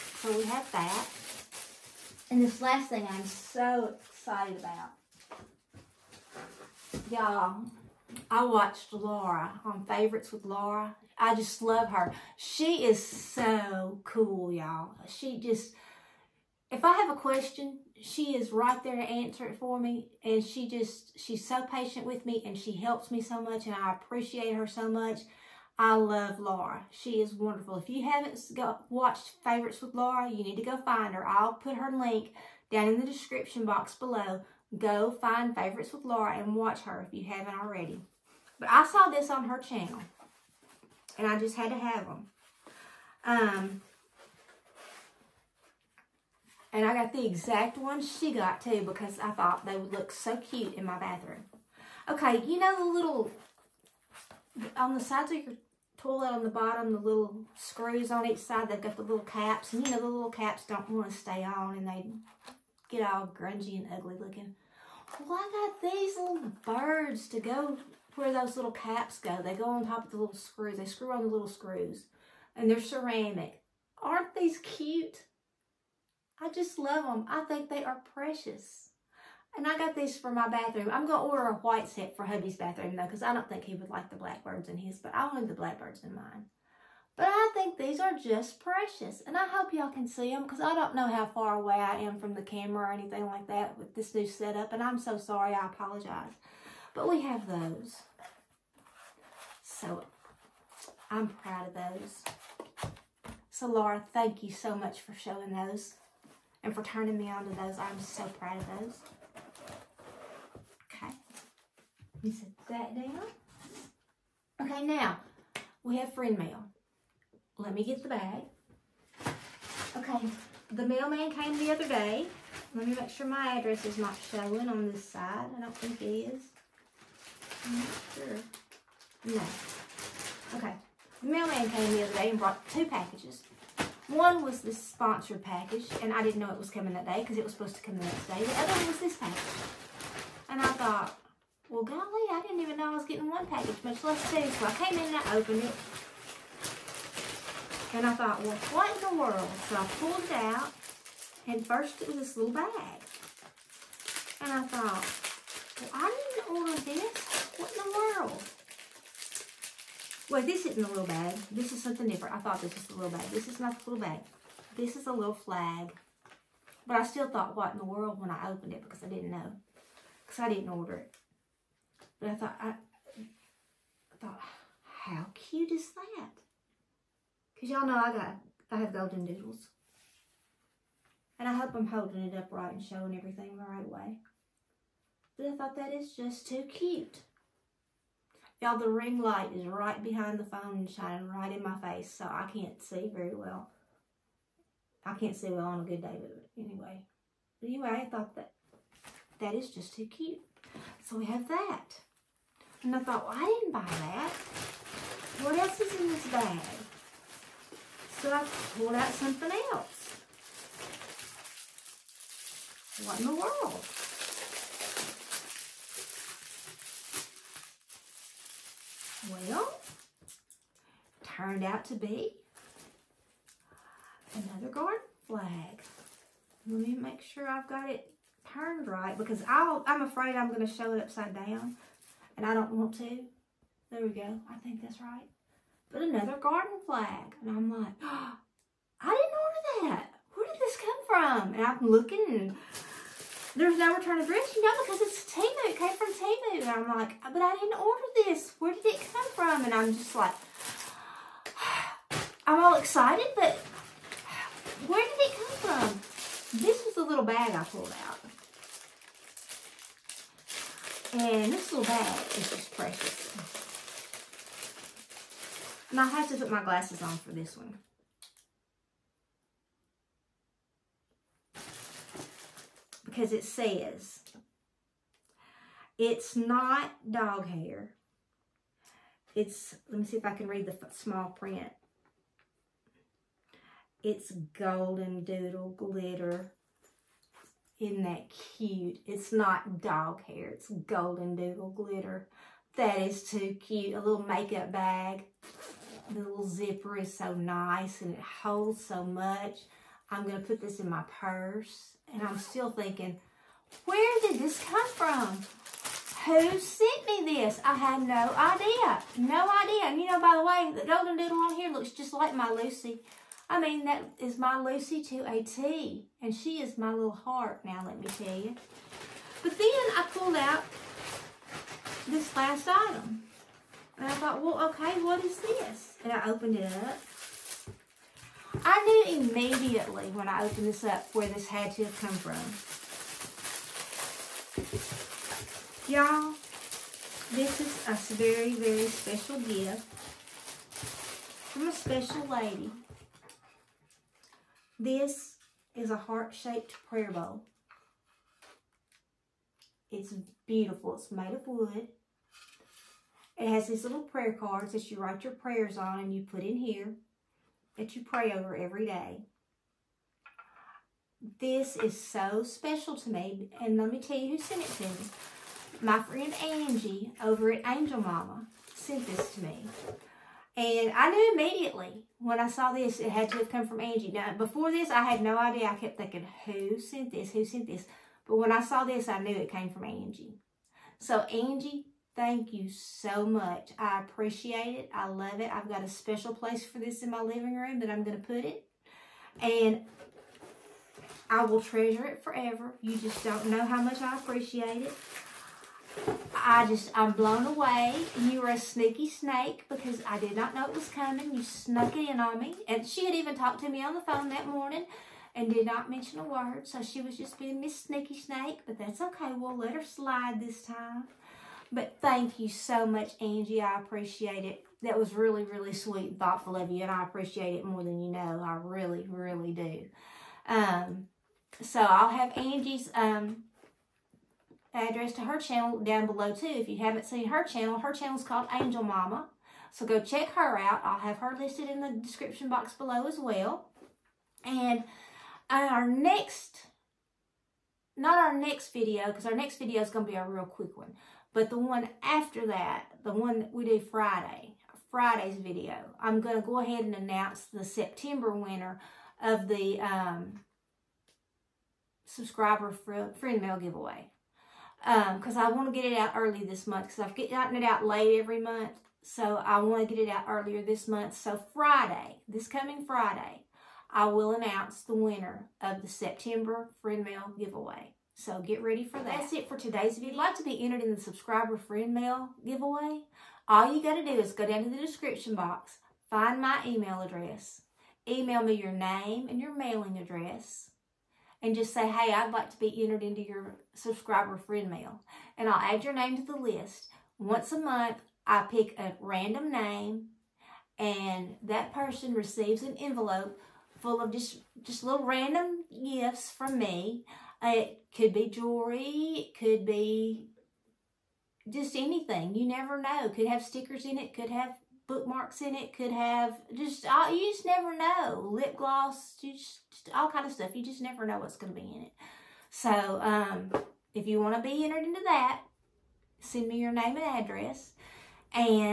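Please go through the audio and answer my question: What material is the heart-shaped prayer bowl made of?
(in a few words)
Wood.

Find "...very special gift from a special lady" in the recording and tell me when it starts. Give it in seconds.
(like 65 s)
338 s.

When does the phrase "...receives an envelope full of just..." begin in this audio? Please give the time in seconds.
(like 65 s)
492 s.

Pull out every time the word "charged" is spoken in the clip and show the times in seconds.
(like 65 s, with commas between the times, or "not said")
not said.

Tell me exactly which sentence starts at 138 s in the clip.
The other one was this package.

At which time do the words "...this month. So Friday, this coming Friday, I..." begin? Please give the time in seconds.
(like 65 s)
460 s.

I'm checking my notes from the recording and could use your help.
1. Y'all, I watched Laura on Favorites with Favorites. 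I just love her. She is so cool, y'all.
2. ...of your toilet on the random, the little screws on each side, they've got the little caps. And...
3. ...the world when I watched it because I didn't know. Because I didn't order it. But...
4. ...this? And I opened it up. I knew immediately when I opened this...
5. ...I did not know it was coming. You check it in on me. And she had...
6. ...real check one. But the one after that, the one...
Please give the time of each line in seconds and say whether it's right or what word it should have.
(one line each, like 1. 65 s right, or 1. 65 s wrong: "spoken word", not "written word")
1. 7 s wrong: "Laura", not "Favorites"
2. 55 s wrong: "bottom", not "random"
3. 167 s wrong: "opened", not "watched"
4. 325 s right
5. 400 s wrong: "snuck", not "check"
6. 440 s wrong: "quick", not "check".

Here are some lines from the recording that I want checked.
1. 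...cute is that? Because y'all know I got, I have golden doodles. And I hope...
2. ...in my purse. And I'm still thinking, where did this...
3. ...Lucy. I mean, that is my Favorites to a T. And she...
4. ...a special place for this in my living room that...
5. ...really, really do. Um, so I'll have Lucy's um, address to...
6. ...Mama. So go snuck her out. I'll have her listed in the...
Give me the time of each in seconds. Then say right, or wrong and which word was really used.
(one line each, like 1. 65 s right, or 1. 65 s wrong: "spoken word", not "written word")
1. 175 s right
2. 300 s right
3. 312 s wrong: "Lucy", not "Favorites"
4. 385 s right
5. 418 s wrong: "Angie", not "Lucy"
6. 428 s wrong: "check", not "snuck".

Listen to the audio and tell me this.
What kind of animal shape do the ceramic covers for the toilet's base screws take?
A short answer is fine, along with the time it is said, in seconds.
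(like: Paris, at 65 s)
Birds, at 66 s.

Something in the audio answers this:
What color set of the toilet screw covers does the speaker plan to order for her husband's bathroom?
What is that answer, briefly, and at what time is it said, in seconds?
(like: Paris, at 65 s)
White, at 81 s.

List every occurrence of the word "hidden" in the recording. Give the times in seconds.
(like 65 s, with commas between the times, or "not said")
not said.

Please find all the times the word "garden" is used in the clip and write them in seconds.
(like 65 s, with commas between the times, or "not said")
224 s, 236 s.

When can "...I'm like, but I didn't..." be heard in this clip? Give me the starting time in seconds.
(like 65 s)
246 s.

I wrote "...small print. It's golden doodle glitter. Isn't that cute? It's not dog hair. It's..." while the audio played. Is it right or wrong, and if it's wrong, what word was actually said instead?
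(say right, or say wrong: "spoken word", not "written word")
right.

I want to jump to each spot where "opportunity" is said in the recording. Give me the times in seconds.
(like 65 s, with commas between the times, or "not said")
not said.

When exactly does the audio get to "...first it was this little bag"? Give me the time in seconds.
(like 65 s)
151 s.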